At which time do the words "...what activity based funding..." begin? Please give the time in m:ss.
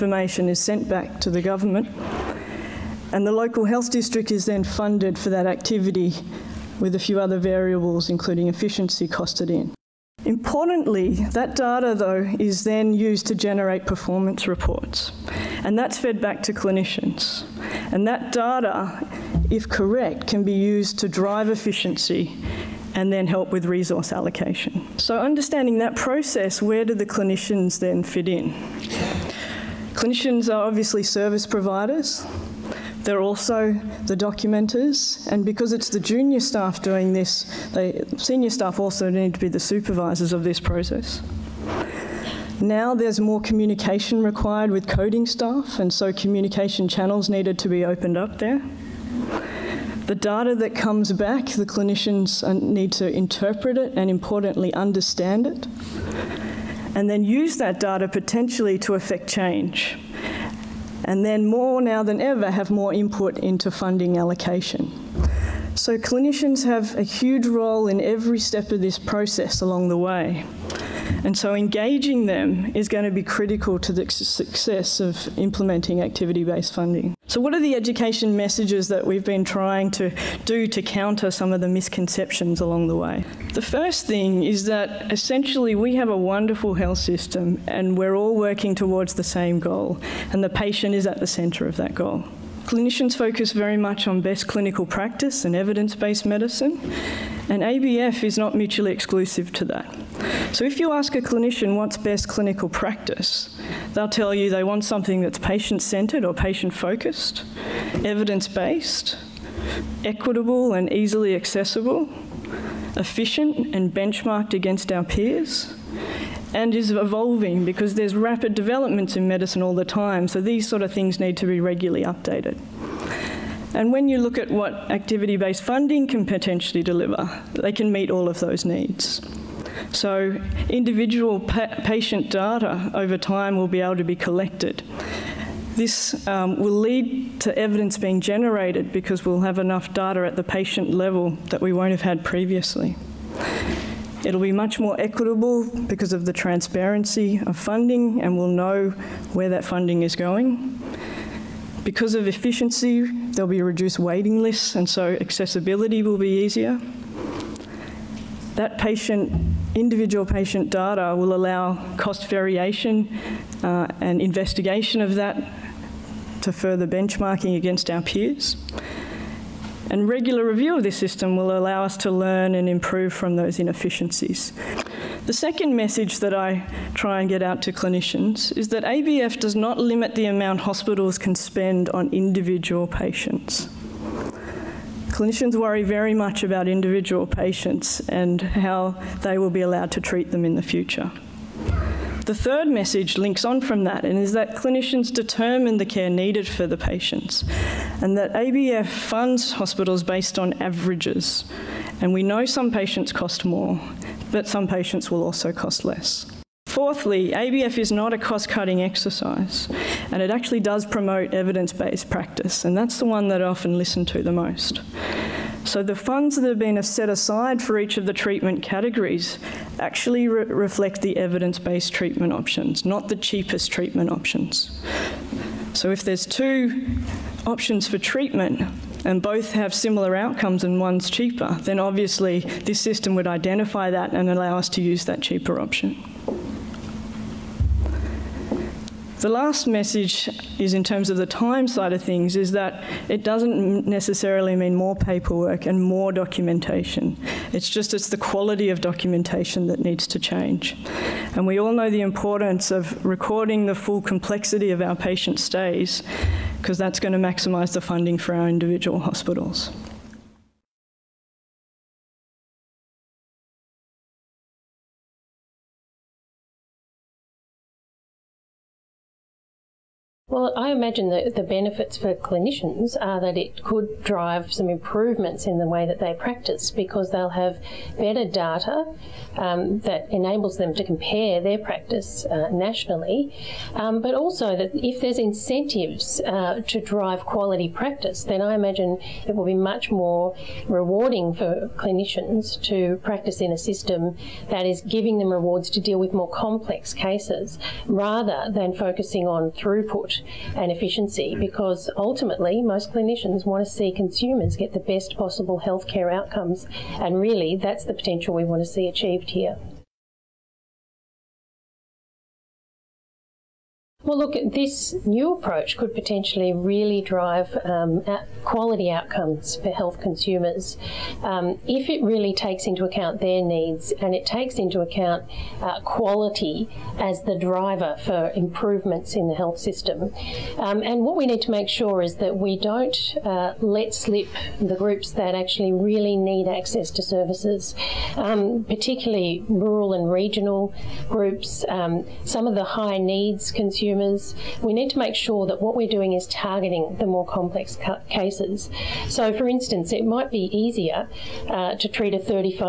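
2:04.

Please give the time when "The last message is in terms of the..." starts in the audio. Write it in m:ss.
3:59.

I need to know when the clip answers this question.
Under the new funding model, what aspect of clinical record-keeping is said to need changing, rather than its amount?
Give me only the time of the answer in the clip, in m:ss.
4:08.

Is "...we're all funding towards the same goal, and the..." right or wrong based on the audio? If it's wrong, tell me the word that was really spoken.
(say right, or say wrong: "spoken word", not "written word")
wrong: "working", not "funding".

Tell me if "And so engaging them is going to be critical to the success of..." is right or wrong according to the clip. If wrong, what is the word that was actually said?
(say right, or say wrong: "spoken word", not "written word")
right.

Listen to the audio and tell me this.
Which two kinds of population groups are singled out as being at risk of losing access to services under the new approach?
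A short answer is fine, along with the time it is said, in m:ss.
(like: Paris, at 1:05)
rural and regional, at 5:39.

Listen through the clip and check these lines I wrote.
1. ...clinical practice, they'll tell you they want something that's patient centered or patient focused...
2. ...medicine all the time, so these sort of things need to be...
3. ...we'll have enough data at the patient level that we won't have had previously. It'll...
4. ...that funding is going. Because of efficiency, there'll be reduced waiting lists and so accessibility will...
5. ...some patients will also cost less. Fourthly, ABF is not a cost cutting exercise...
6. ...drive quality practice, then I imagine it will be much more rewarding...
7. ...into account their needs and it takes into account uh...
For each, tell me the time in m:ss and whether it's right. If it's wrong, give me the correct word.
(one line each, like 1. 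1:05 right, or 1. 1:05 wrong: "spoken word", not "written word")
1. 1:42 right
2. 1:59 right
3. 2:19 right
4. 2:29 right
5. 3:24 right
6. 4:46 right
7. 5:22 right.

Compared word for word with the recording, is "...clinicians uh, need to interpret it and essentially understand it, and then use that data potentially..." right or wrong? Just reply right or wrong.
wrong.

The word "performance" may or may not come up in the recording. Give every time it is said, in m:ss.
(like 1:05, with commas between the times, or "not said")
0:13.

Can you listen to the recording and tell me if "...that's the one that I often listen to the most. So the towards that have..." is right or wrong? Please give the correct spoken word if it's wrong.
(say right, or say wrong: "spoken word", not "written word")
wrong: "funds", not "towards".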